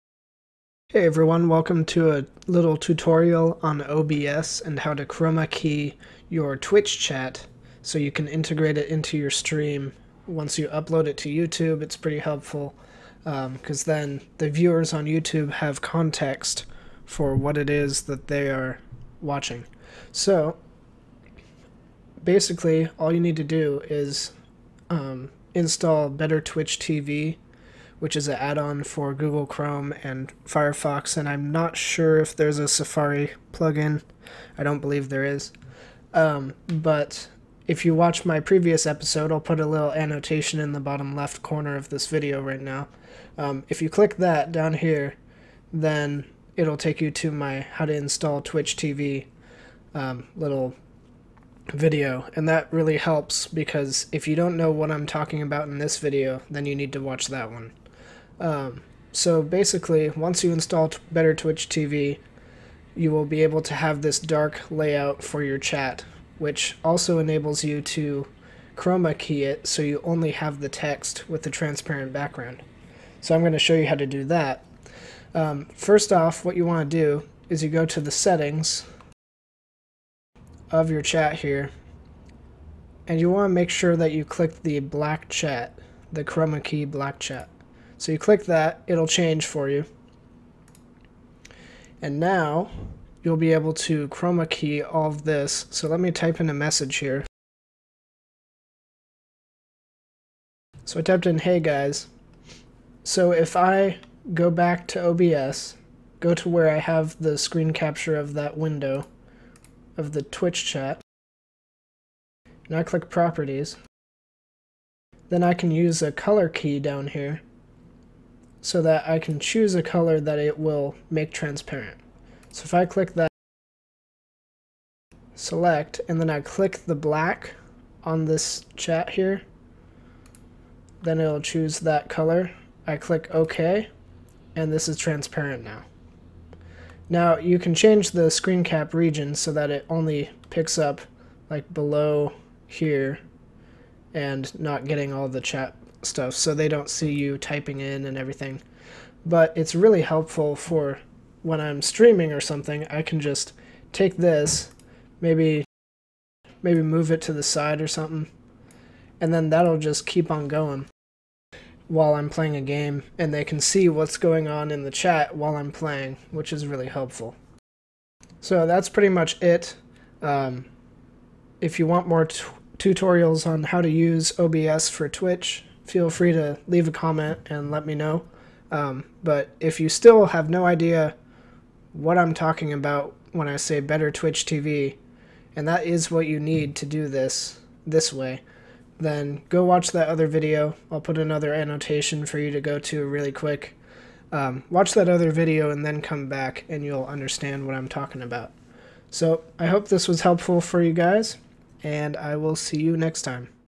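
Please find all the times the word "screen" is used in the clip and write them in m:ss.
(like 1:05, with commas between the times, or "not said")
1:47, 2:18.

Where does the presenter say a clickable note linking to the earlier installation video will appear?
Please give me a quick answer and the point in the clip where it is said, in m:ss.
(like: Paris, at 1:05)
bottom left corner, at 0:40.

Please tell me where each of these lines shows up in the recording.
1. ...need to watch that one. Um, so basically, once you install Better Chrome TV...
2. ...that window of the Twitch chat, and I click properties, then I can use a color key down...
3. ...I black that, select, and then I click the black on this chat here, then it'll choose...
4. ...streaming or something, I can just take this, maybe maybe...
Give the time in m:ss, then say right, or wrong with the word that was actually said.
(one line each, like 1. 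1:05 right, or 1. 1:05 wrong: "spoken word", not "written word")
1. 0:56 wrong: "Twitch", not "Chrome"
2. 1:48 right
3. 2:02 wrong: "click", not "black"
4. 2:31 right.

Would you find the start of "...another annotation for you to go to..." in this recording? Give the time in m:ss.
3:11.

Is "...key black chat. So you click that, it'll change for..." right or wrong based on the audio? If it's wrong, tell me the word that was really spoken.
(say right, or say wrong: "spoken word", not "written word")
right.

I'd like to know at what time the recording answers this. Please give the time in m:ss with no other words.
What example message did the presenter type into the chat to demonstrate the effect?
1:41.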